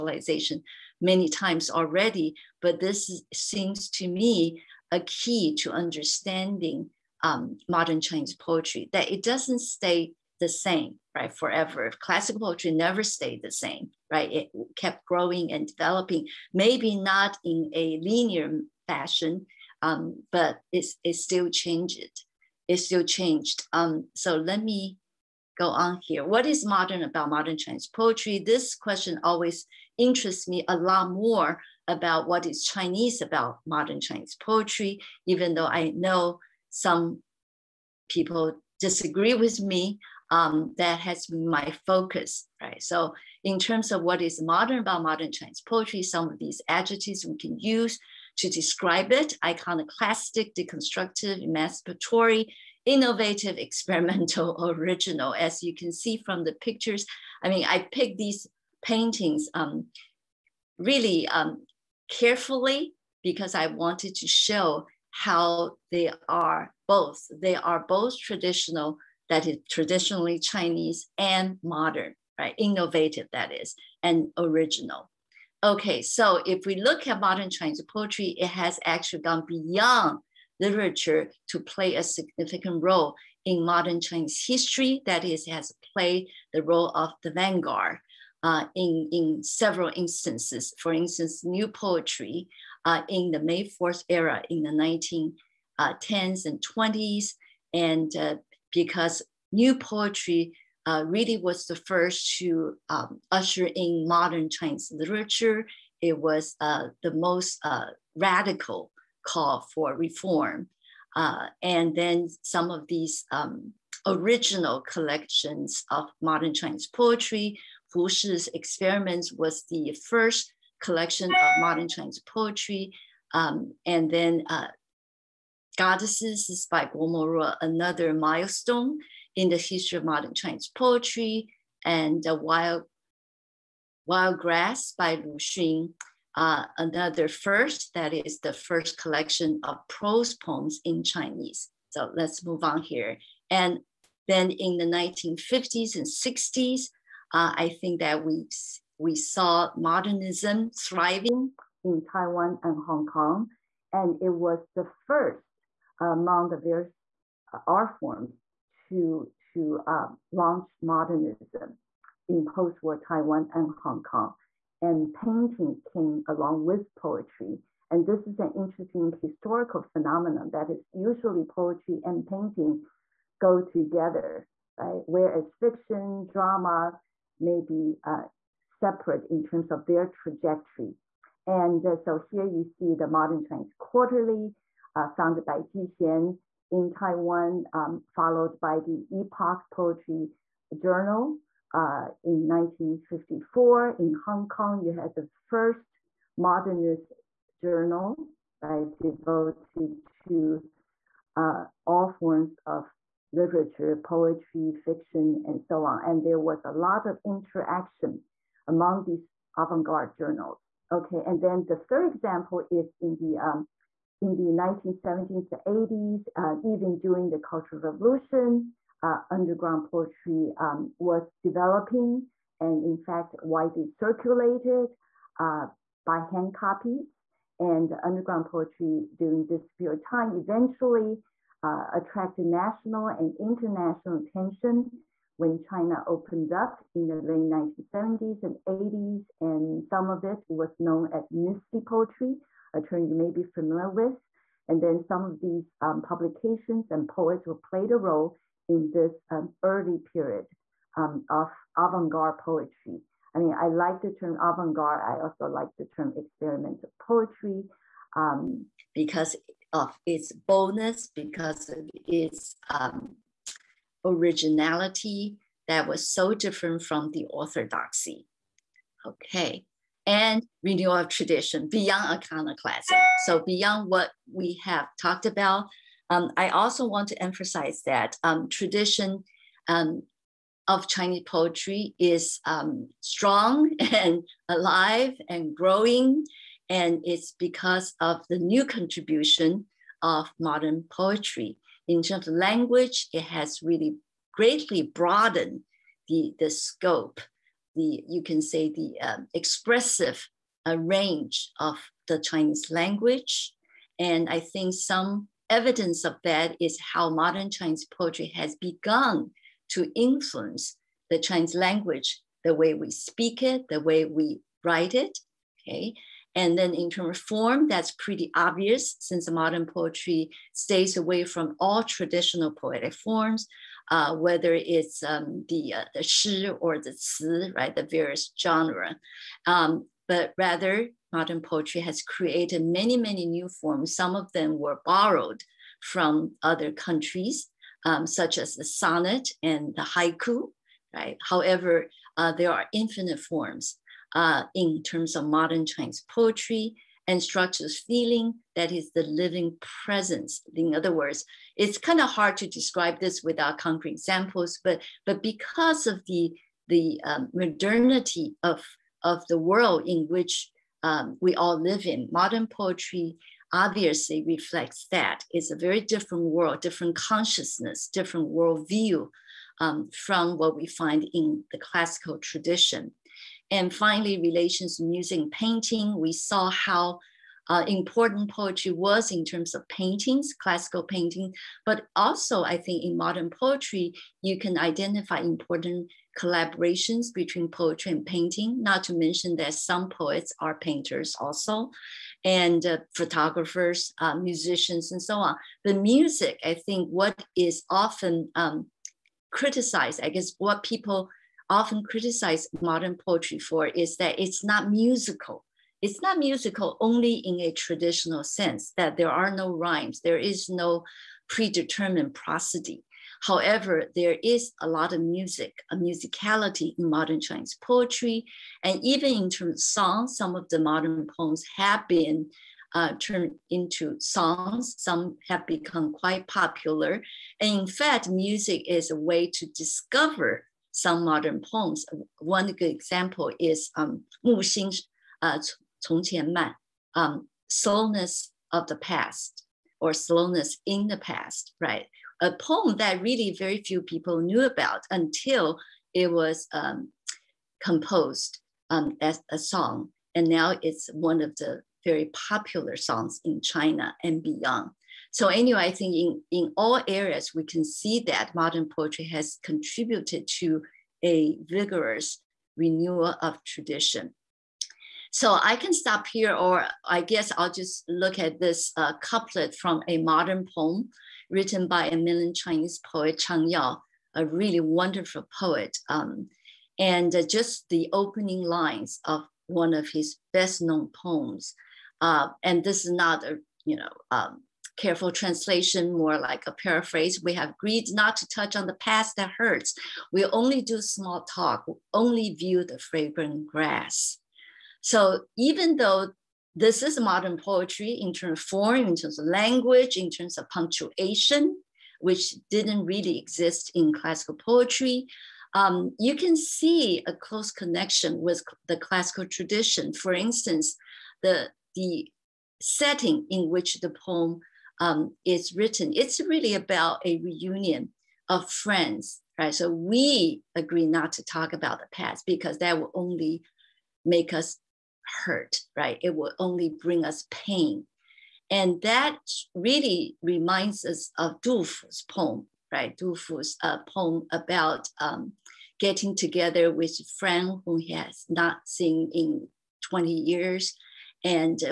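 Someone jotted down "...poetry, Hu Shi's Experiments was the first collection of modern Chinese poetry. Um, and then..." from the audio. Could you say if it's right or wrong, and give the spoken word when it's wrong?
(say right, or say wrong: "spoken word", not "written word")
right.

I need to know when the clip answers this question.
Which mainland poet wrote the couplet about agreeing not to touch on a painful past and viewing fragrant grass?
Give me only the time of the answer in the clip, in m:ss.
7:53.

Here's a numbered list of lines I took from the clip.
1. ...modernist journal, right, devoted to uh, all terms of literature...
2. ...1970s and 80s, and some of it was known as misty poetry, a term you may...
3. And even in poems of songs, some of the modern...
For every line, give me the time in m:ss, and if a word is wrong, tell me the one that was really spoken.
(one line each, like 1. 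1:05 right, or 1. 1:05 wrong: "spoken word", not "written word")
1. 3:16 wrong: "forms", not "terms"
2. 3:57 right
3. 6:58 wrong: "terms", not "poems".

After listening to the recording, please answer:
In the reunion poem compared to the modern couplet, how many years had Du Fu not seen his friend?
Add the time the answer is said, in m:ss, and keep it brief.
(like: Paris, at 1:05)
20, at 8:59.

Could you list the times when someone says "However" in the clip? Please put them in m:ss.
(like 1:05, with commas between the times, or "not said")
5:41, 6:53.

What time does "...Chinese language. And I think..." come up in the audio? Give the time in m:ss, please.
5:02.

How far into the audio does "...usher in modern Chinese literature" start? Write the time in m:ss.
1:43.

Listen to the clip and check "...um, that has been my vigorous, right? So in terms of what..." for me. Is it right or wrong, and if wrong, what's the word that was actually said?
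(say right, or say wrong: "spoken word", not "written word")
wrong: "focus", not "vigorous".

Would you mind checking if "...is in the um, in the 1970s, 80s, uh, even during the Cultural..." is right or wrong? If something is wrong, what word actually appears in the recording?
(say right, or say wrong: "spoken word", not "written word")
right.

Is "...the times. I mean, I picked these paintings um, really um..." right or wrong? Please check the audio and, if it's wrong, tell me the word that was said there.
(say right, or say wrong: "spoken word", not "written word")
wrong: "pictures", not "times".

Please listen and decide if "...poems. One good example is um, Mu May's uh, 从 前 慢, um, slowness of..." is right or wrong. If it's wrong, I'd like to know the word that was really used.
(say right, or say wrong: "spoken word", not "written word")
wrong: "Xing", not "May".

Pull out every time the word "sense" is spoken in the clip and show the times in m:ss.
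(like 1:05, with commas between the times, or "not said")
6:48.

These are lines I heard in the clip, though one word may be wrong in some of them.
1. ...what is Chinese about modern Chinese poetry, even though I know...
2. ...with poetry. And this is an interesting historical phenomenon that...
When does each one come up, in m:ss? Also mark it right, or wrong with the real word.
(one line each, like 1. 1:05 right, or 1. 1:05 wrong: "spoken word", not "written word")
1. 0:32 right
2. 2:46 right.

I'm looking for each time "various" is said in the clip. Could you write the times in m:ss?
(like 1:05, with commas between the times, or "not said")
2:36, 5:27.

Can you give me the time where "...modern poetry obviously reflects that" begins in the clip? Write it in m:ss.
6:02.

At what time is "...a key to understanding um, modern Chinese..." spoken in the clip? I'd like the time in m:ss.
0:04.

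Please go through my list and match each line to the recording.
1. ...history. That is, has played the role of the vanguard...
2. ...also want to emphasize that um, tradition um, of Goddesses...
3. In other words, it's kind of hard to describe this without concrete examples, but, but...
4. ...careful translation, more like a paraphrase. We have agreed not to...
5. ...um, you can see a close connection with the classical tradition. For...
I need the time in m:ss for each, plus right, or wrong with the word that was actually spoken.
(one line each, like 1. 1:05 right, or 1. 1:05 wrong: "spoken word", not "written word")
1. 1:24 right
2. 4:36 wrong: "Chinese", not "Goddesses"
3. 5:50 right
4. 8:04 right
5. 8:25 right.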